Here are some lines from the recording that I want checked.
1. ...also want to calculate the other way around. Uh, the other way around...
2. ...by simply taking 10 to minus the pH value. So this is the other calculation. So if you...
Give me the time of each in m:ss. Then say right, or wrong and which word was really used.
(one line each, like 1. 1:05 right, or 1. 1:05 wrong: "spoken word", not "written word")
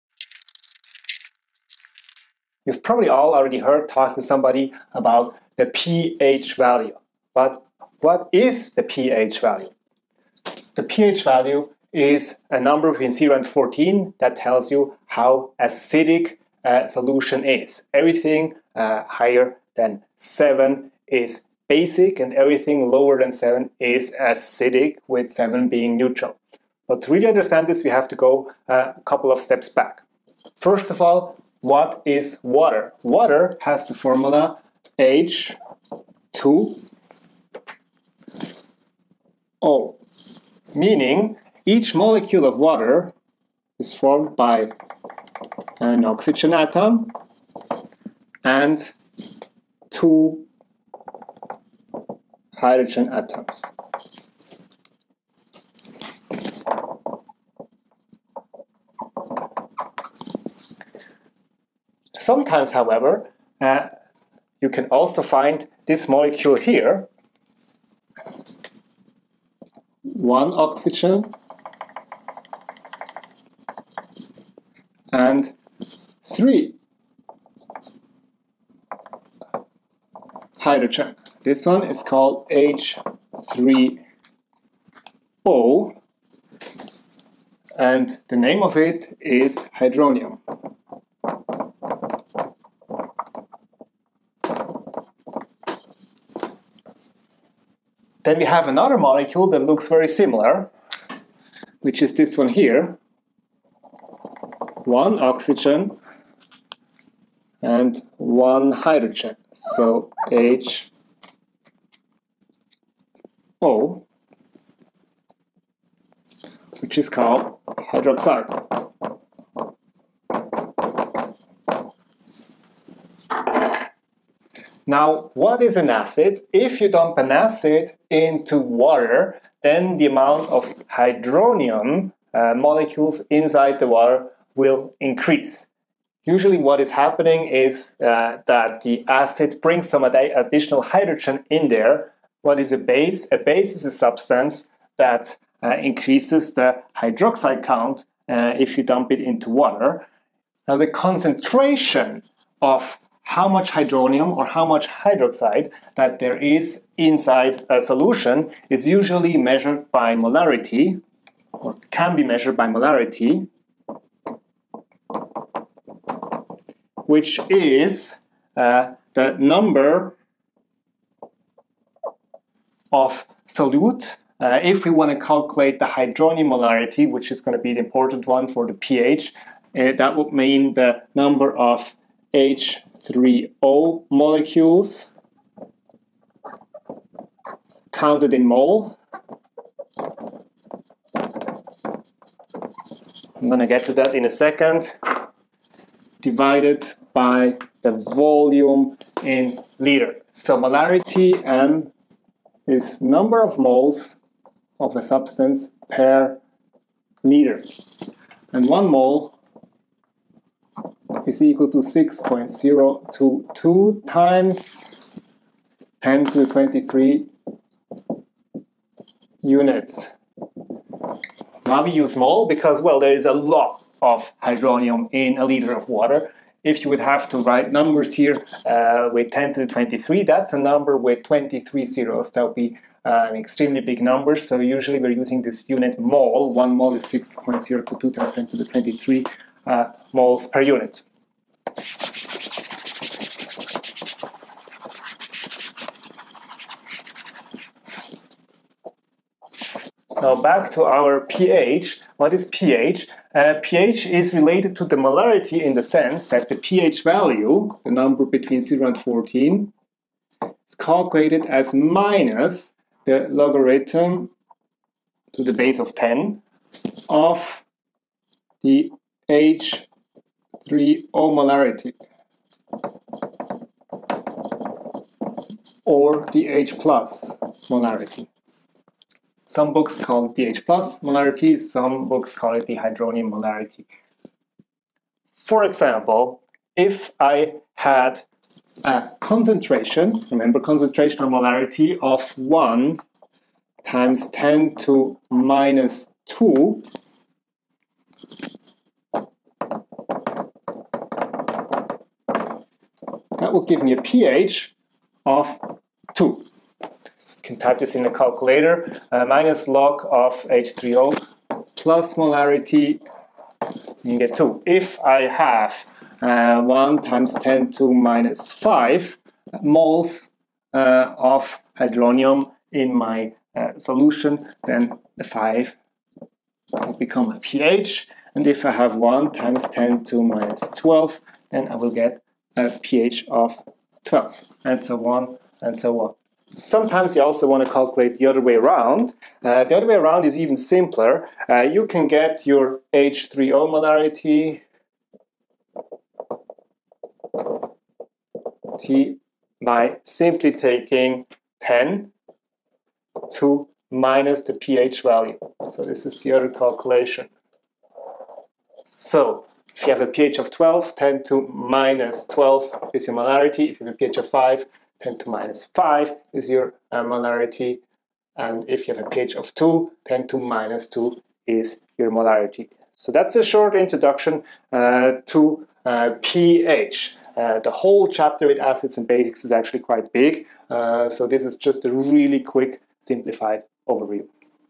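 1. 5:37 right
2. 5:49 right.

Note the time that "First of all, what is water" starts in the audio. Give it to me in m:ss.
0:30.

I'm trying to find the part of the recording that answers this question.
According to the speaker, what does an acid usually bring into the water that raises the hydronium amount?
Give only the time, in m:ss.
2:20.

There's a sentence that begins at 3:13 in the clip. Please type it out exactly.
I'm going to get to that in a second.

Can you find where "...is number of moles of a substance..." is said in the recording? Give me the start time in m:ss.
3:22.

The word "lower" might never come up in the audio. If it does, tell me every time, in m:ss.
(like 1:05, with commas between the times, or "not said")
0:22.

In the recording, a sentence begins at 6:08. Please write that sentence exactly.
And if you have a pH of 2, 10 to minus 2 is your molarity.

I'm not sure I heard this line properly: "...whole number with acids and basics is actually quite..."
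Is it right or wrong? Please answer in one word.
wrong.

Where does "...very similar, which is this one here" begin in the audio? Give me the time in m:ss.
1:39.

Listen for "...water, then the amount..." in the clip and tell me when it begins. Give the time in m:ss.
2:08.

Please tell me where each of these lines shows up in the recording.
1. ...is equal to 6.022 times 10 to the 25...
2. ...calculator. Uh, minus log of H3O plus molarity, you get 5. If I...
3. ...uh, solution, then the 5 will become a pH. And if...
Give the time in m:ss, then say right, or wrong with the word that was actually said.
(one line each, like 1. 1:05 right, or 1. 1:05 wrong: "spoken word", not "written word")
1. 3:31 wrong: "23", not "25"
2. 5:08 wrong: "2", not "5"
3. 5:23 right.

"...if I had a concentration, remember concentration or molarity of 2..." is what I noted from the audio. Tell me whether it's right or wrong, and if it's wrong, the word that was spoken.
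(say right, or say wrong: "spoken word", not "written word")
wrong: "1", not "2".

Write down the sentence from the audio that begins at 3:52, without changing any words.
That would be uh, an extremely big number.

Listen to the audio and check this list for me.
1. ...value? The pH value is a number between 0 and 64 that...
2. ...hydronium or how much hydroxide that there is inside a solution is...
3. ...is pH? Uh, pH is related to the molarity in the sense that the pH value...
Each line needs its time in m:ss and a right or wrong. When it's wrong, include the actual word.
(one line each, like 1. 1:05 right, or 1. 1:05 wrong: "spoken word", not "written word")
1. 0:09 wrong: "14", not "64"
2. 2:33 right
3. 4:12 right.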